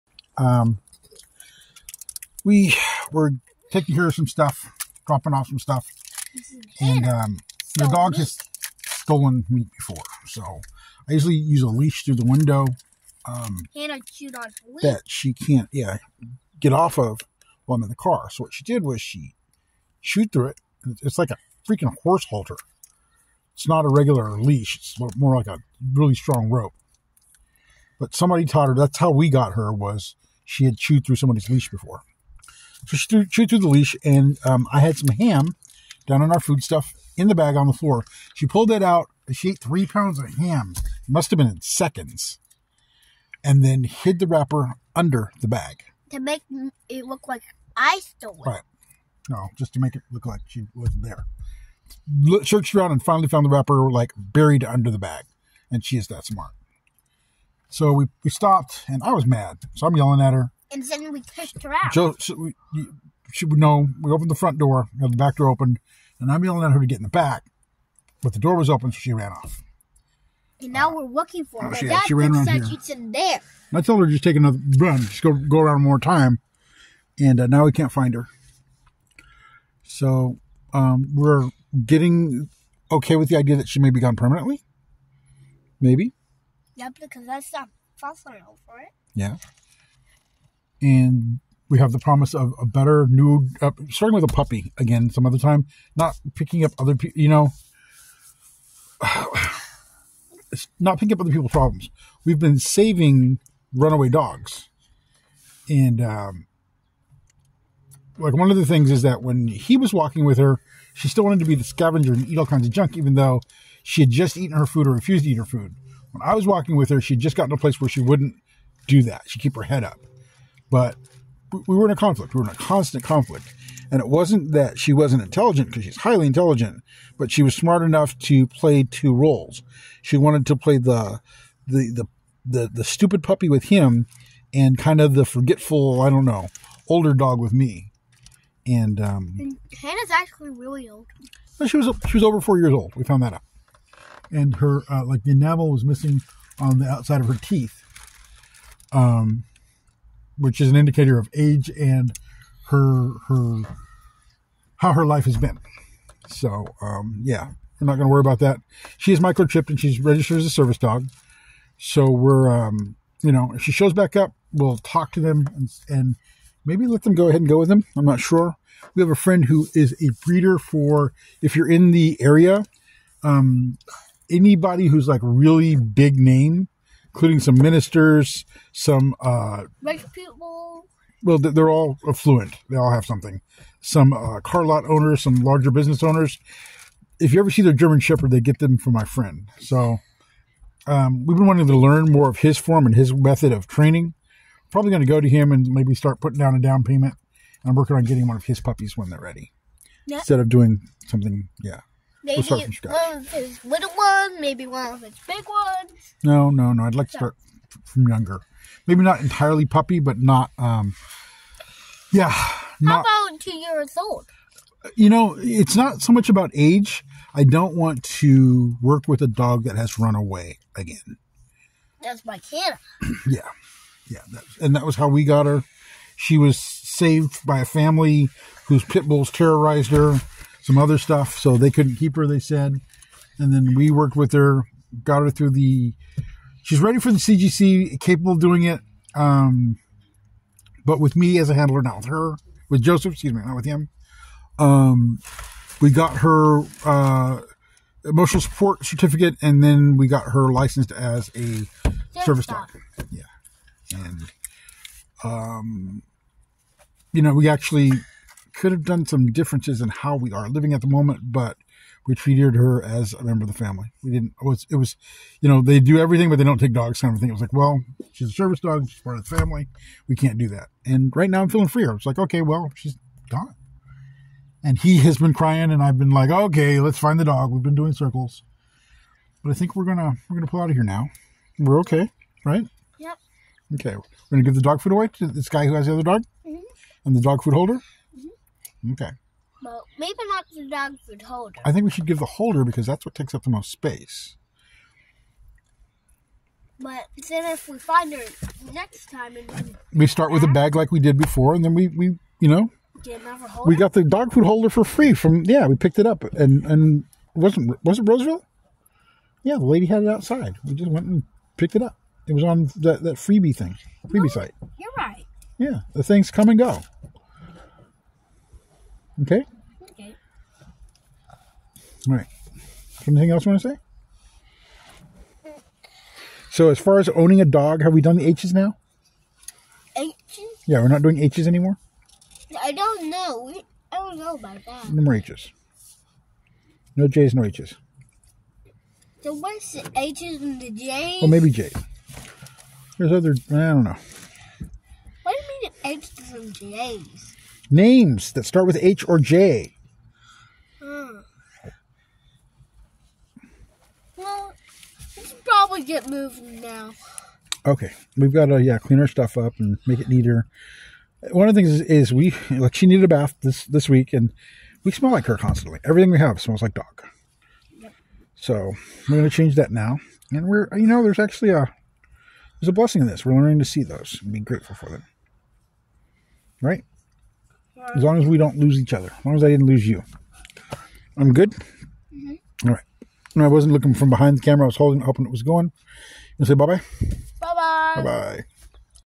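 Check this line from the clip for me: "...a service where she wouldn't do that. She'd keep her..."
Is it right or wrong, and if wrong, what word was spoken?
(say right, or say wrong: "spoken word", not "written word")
wrong: "place", not "service".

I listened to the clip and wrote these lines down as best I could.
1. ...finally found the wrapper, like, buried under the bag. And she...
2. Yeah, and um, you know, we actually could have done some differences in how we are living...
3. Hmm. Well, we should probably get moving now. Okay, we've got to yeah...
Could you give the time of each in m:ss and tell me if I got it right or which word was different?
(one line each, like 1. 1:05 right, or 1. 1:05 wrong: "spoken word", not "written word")
1. 0:53 right
2. 4:13 right
3. 5:50 right.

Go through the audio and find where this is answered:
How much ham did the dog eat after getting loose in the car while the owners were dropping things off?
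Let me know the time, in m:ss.
0:39.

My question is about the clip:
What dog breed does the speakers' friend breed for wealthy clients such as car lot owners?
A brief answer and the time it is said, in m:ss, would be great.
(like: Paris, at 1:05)
German Shepherd, at 3:07.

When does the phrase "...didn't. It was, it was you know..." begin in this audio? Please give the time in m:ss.
4:24.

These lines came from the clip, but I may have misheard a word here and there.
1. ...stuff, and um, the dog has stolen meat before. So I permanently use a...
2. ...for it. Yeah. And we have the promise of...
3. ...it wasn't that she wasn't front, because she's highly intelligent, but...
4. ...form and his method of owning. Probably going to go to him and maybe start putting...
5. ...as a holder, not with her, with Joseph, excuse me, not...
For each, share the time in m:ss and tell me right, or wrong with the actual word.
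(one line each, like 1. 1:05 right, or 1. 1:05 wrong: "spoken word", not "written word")
1. 0:05 wrong: "usually", not "permanently"
2. 1:28 right
3. 2:03 wrong: "intelligent", not "front"
4. 3:12 wrong: "training", not "owning"
5. 4:01 wrong: "handler", not "holder".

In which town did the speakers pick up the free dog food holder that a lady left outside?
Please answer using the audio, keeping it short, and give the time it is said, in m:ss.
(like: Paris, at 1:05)
Roseville, at 5:08.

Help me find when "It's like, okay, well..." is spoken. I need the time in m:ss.
4:31.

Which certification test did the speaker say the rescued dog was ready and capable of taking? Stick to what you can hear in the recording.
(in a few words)
CGC.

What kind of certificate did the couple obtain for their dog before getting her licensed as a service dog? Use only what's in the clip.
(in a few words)
emotional support certificate.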